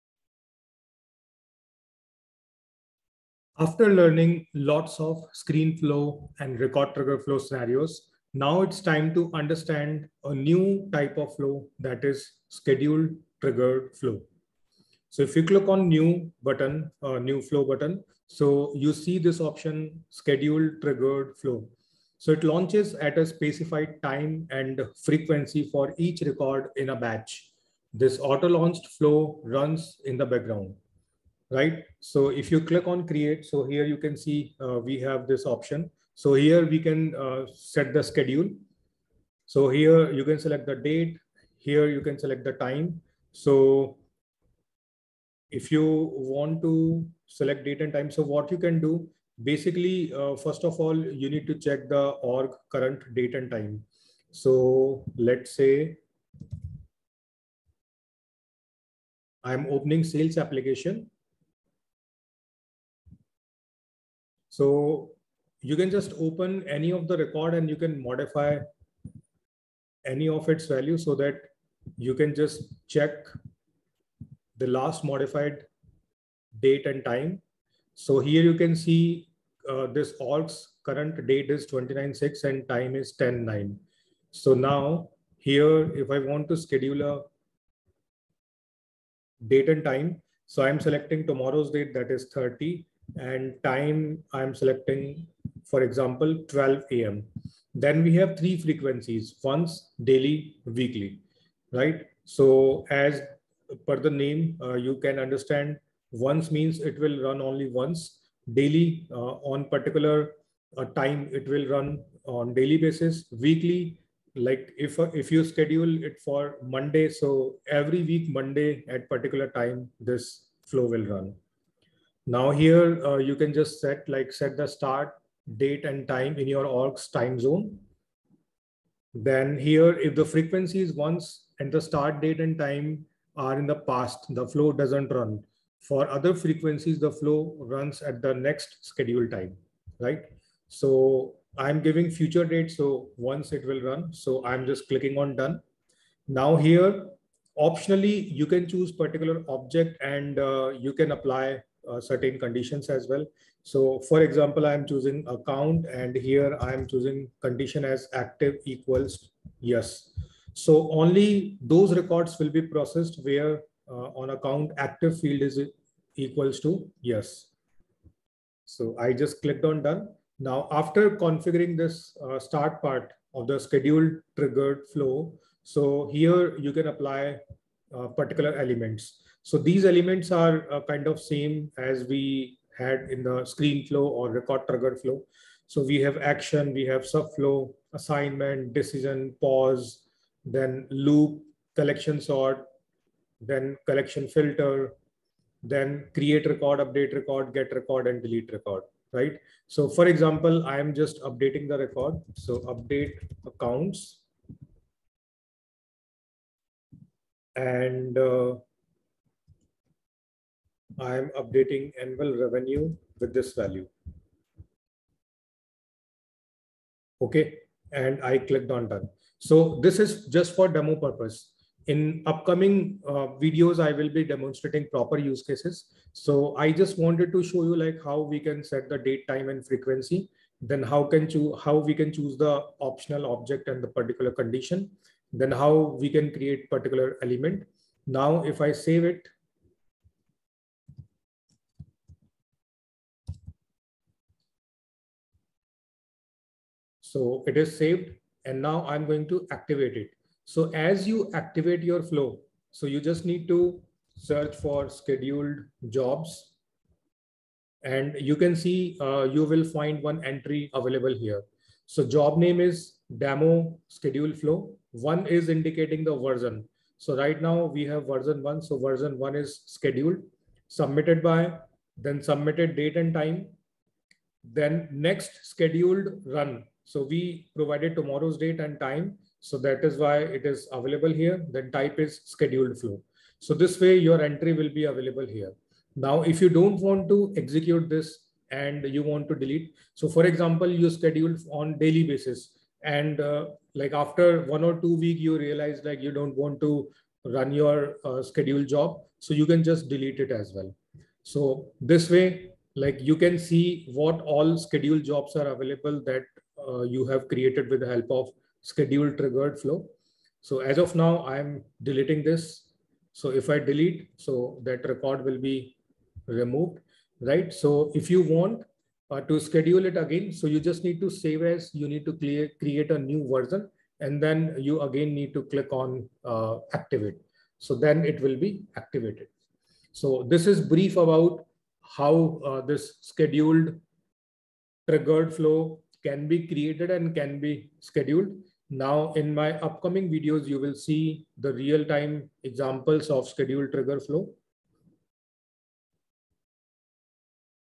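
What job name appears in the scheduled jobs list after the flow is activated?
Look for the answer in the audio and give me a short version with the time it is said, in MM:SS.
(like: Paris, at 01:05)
Demo schedule flow, at 04:23.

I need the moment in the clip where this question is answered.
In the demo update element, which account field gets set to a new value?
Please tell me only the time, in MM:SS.
03:32.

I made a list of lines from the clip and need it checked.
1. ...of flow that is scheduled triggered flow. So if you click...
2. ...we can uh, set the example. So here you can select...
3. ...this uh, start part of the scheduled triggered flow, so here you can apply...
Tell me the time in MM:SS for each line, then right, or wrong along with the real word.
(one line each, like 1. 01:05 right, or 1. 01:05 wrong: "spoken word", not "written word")
1. 00:11 right
2. 00:36 wrong: "schedule", not "example"
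3. 02:51 right.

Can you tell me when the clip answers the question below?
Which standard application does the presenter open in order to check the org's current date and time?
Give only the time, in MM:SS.
01:00.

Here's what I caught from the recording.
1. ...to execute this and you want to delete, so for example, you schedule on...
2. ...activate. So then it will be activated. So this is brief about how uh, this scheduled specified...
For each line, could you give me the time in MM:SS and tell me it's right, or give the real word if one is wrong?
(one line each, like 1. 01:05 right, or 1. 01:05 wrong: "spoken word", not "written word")
1. 04:47 right
2. 05:26 wrong: "triggered", not "specified".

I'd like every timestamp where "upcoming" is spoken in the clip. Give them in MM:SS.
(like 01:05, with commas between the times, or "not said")
03:42, 05:39.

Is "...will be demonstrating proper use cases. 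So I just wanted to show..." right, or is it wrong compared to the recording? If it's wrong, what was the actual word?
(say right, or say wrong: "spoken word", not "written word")
right.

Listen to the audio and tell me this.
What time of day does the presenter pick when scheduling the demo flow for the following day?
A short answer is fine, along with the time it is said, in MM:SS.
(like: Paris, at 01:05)
12 a.m., at 01:36.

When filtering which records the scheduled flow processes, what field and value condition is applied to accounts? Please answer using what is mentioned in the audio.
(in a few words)
Active equals yes.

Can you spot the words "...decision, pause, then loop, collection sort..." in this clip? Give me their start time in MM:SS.
03:08.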